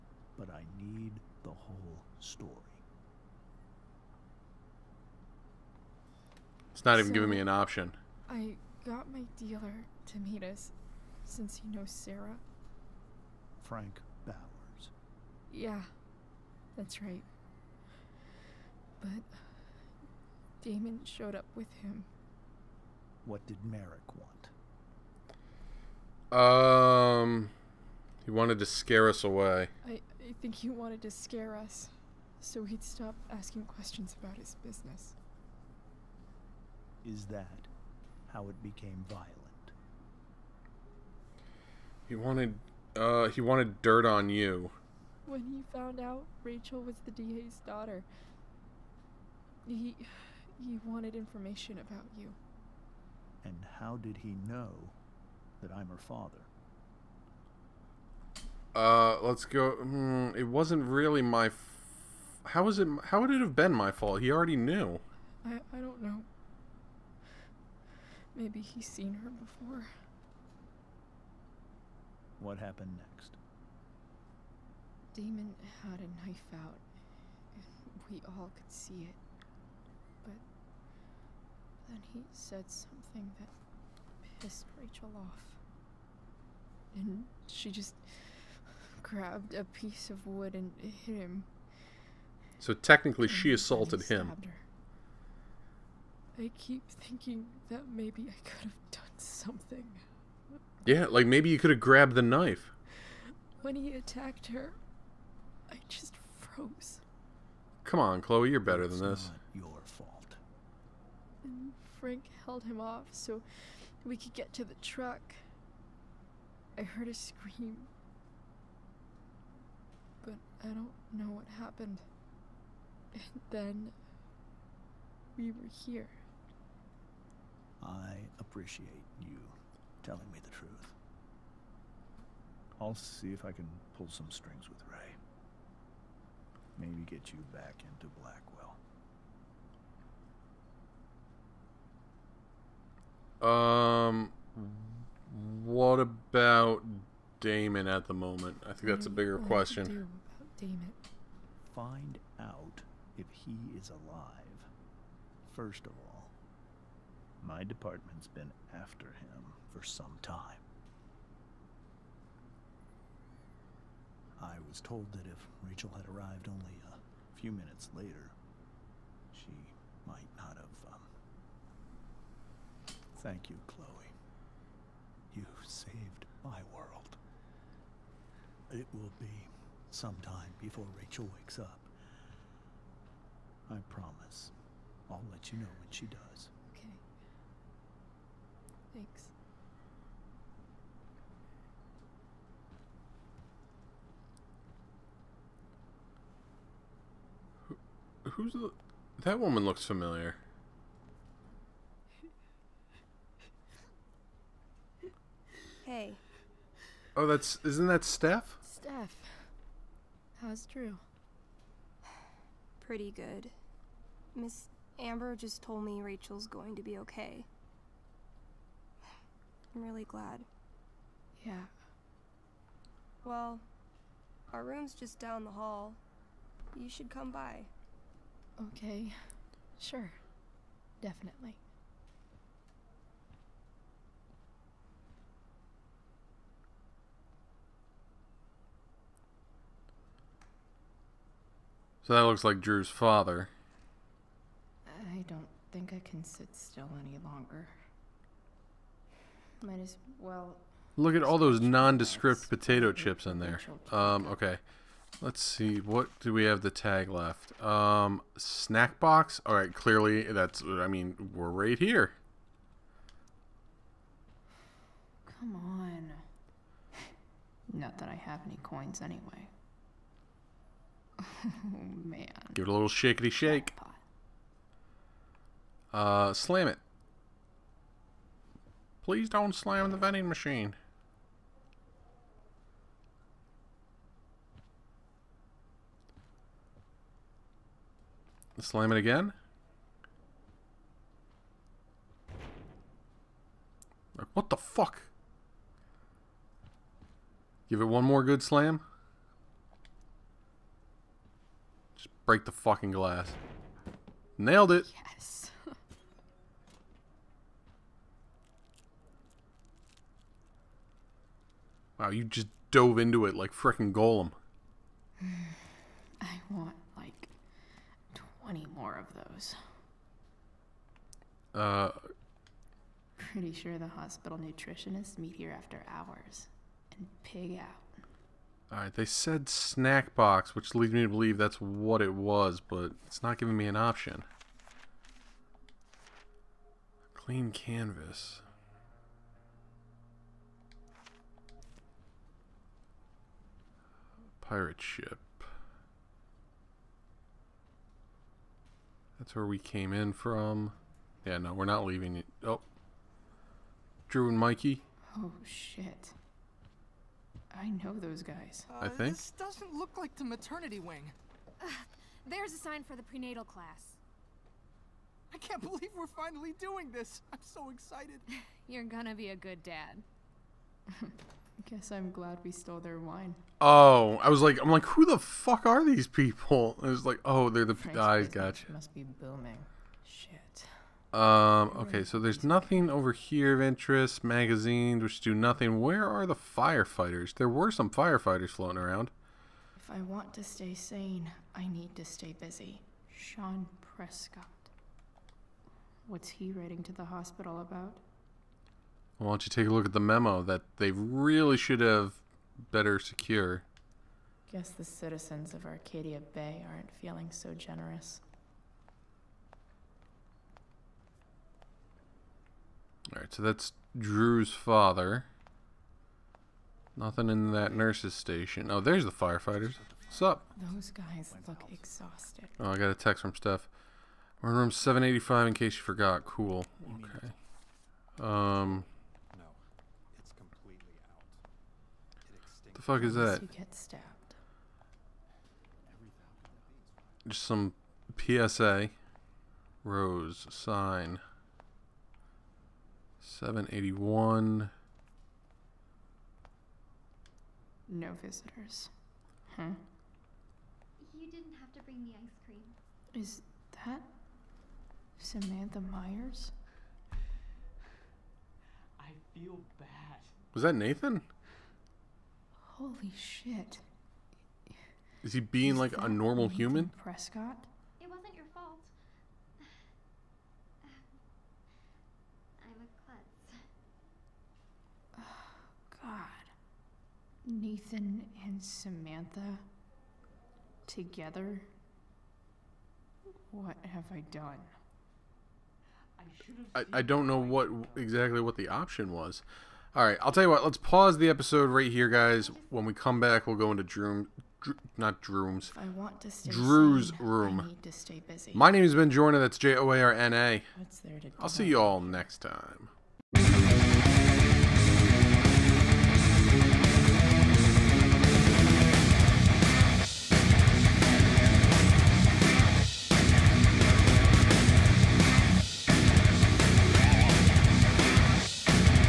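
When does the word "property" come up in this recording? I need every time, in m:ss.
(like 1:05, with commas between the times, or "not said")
not said.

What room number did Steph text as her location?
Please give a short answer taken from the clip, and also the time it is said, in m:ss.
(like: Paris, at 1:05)
785, at 7:04.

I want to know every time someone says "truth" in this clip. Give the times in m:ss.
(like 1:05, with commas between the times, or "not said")
2:10.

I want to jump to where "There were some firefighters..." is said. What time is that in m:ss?
6:27.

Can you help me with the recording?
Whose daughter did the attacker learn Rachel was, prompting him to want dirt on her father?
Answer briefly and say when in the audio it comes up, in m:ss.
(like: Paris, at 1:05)
The DA, at 0:47.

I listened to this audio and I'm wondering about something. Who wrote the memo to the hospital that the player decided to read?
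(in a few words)
Sean Prescott.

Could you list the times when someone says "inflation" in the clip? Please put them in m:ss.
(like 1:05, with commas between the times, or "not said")
not said.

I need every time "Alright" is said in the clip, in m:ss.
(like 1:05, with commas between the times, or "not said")
5:28, 6:53.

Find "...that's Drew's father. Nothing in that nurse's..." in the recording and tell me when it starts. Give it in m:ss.
6:53.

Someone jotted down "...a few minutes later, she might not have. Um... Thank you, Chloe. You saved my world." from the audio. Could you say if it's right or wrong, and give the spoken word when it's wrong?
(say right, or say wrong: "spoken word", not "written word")
right.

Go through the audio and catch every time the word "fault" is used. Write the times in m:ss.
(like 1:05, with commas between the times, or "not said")
1:03, 1:49, 7:48.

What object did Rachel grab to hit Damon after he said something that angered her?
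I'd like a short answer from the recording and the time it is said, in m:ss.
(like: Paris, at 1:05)
A piece of wood, at 1:29.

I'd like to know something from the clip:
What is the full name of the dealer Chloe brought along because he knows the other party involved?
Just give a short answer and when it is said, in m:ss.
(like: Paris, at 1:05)
Frank Bowers, at 0:13.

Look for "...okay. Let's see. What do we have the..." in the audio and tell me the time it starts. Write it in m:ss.
4:14.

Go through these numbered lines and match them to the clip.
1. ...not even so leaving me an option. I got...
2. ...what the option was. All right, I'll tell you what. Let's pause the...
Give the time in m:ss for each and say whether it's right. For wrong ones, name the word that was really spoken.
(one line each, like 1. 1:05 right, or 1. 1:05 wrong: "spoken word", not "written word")
1. 0:06 wrong: "giving", not "leaving"
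2. 8:08 right.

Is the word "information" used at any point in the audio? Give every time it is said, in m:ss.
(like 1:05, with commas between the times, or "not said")
0:51.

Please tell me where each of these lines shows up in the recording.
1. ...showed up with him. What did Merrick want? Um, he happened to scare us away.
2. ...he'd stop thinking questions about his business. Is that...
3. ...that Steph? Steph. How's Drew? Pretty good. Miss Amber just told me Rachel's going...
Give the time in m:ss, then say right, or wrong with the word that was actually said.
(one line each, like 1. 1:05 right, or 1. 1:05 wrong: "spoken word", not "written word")
1. 0:21 wrong: "wanted", not "happened"
2. 0:32 wrong: "asking", not "thinking"
3. 3:27 right.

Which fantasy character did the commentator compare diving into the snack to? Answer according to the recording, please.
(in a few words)
Gollum.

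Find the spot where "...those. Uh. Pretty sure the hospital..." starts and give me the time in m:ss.
5:19.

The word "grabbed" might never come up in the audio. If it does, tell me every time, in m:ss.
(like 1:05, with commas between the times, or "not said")
1:29, 1:41.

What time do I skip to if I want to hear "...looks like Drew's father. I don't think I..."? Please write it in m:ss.
4:02.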